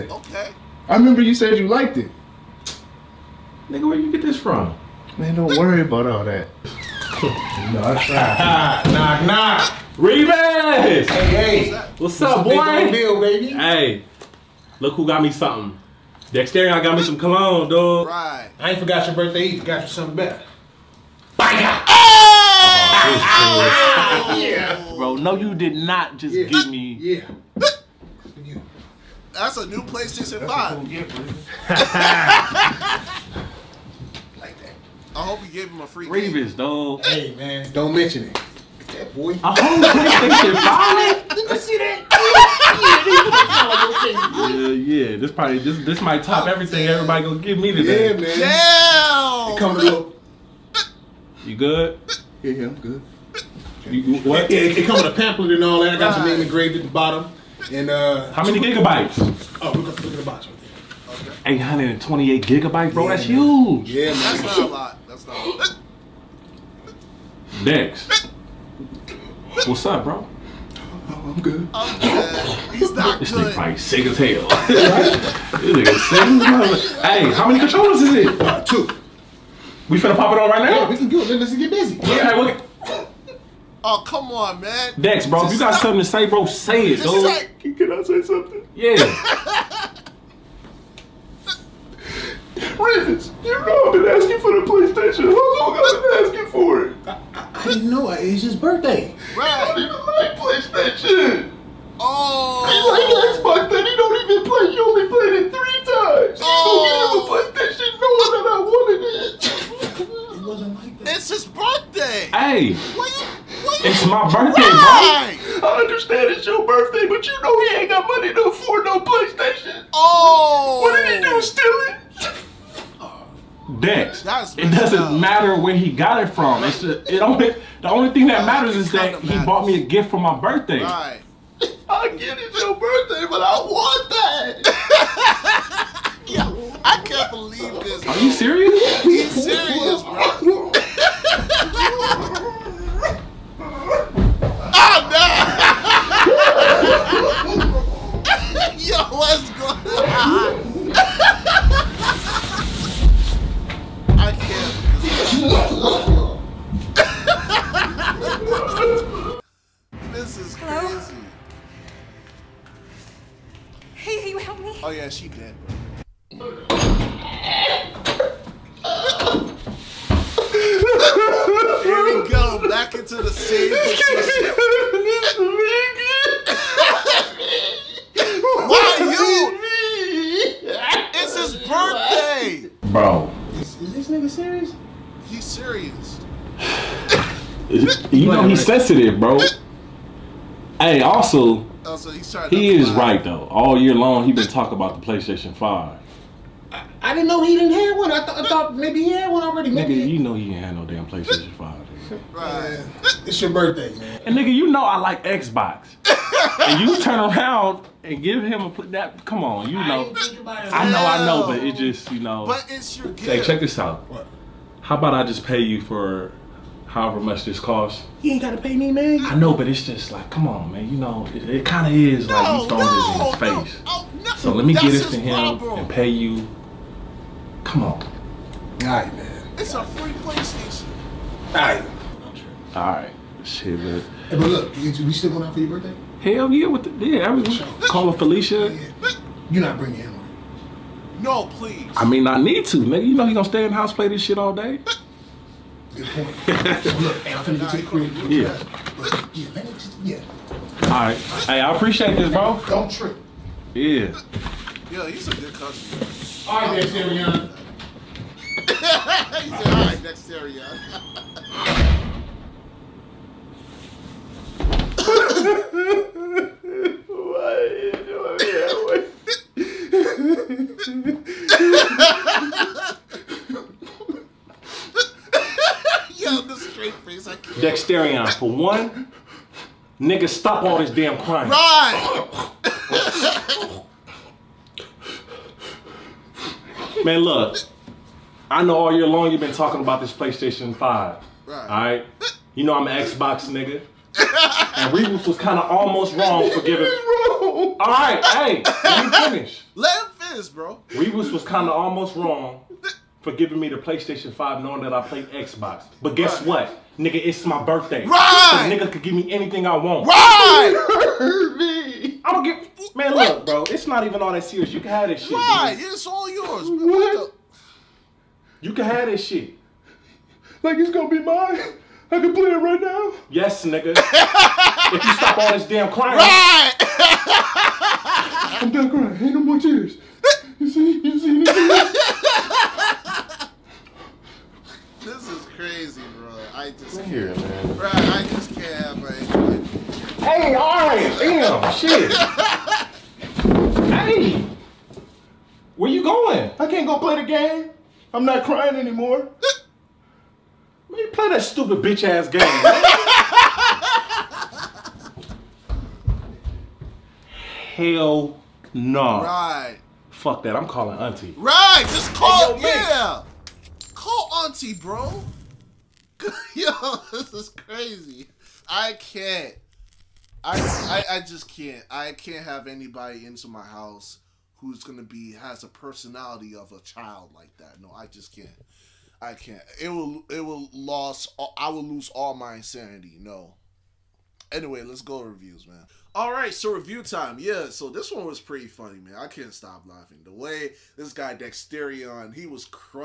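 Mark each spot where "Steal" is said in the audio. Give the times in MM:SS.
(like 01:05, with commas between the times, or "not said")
02:01.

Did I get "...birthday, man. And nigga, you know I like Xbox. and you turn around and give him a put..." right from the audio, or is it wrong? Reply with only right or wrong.
right.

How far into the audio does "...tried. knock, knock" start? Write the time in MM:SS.
00:08.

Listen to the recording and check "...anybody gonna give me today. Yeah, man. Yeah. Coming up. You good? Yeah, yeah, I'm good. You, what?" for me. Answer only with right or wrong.
wrong.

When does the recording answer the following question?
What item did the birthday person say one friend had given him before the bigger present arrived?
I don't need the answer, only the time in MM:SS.
00:17.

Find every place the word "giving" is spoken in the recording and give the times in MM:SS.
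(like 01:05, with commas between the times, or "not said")
04:56, 05:03.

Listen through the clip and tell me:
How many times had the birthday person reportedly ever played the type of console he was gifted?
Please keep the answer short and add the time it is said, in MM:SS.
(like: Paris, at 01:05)
3, at 01:45.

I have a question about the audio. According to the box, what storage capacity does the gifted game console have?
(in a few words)
828 gigabytes.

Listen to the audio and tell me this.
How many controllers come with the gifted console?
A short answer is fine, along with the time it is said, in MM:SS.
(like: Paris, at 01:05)
2, at 01:18.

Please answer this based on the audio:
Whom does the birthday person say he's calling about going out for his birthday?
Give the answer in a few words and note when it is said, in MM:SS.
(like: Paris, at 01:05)
Felicia, at 03:58.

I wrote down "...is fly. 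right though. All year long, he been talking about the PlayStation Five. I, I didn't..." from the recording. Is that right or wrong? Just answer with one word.
right.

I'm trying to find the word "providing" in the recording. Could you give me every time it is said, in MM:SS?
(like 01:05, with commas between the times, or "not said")
not said.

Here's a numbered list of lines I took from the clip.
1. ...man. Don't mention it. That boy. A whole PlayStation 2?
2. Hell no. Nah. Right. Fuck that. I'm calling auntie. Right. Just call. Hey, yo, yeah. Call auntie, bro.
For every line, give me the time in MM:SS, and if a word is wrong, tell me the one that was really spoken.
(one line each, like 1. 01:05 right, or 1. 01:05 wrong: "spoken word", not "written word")
1. 00:37 wrong: "5", not "2"
2. 05:57 right.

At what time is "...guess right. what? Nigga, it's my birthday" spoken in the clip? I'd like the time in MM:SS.
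05:06.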